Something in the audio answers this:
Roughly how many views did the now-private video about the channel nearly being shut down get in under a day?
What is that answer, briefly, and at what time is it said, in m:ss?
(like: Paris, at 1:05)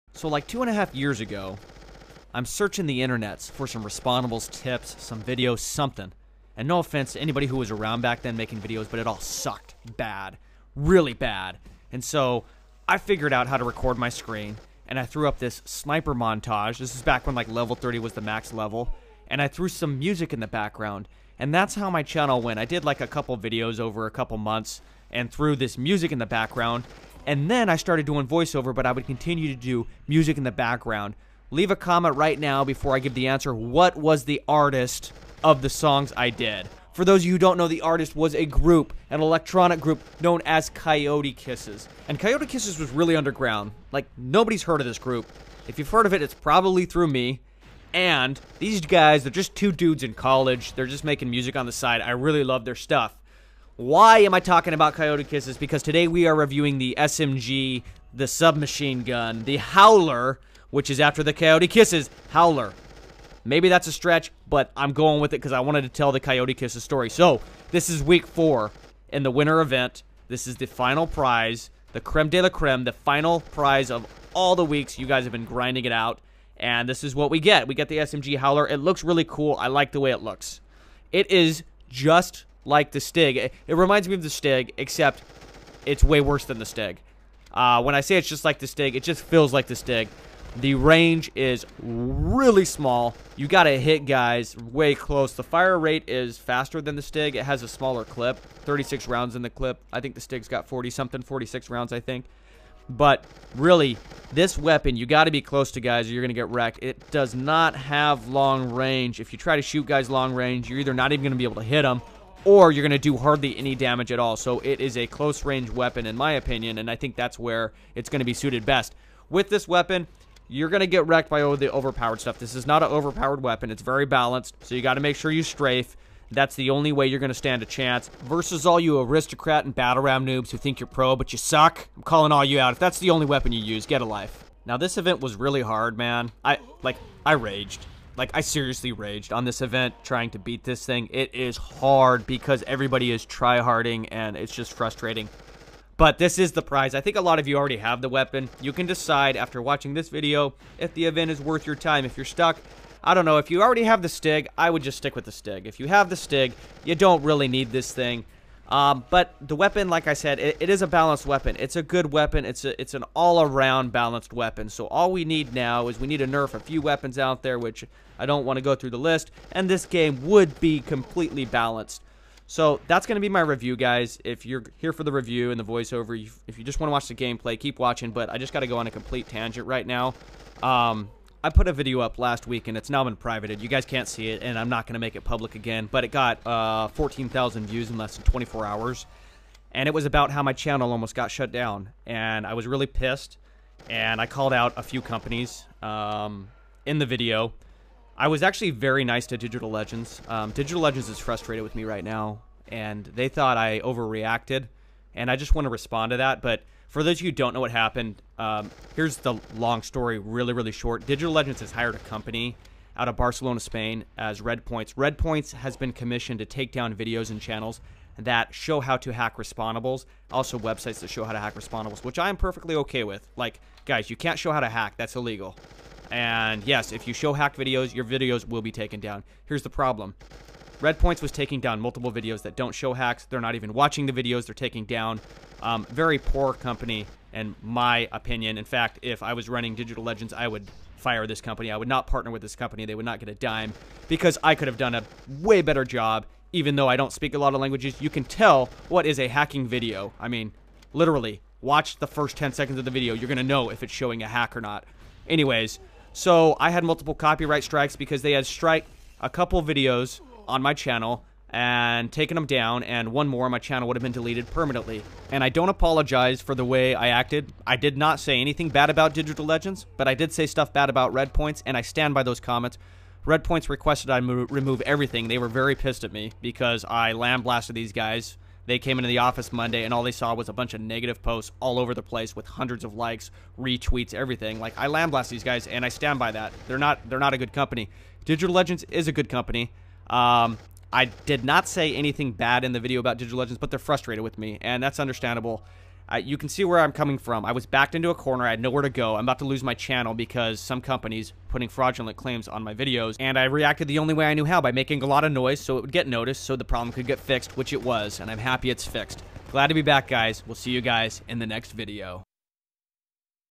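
14,000, at 3:06.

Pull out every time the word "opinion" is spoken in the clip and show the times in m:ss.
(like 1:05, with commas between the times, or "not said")
1:56, 3:58.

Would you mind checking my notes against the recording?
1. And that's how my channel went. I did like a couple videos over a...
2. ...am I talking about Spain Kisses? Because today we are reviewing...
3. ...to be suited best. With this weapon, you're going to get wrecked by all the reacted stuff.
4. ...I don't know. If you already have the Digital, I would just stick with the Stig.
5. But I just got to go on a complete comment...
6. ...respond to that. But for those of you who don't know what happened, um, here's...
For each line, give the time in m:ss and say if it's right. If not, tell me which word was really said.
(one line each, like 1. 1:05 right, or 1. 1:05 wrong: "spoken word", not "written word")
1. 0:21 right
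2. 0:54 wrong: "Coyote", not "Spain"
3. 1:58 wrong: "overpowered", not "reacted"
4. 2:33 wrong: "Stig", not "Digital"
5. 2:58 wrong: "tangent", not "comment"
6. 3:25 right.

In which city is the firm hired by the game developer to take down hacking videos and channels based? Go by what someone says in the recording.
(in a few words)
Barcelona.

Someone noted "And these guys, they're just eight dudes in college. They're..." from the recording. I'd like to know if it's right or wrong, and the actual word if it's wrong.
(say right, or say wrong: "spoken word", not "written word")
wrong: "two", not "eight".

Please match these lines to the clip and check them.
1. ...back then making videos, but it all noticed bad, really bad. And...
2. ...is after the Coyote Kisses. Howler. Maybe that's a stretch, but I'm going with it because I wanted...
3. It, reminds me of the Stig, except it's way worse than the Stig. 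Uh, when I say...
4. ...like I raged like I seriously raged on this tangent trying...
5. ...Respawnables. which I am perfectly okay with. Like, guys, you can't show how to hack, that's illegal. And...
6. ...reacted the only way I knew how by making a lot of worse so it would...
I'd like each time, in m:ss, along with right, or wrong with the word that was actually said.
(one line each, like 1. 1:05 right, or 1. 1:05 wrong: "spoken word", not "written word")
1. 0:08 wrong: "sucked", not "noticed"
2. 1:00 right
3. 1:23 right
4. 2:16 wrong: "event", not "tangent"
5. 3:41 right
6. 5:03 wrong: "noise", not "worse".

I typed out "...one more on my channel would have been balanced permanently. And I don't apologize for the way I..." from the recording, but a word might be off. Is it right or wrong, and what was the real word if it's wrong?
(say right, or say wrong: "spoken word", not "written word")
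wrong: "deleted", not "balanced".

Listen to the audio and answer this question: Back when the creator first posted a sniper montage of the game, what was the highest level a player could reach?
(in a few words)
30.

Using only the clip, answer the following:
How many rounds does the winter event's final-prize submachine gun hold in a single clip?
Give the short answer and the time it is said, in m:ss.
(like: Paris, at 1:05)
36, at 1:38.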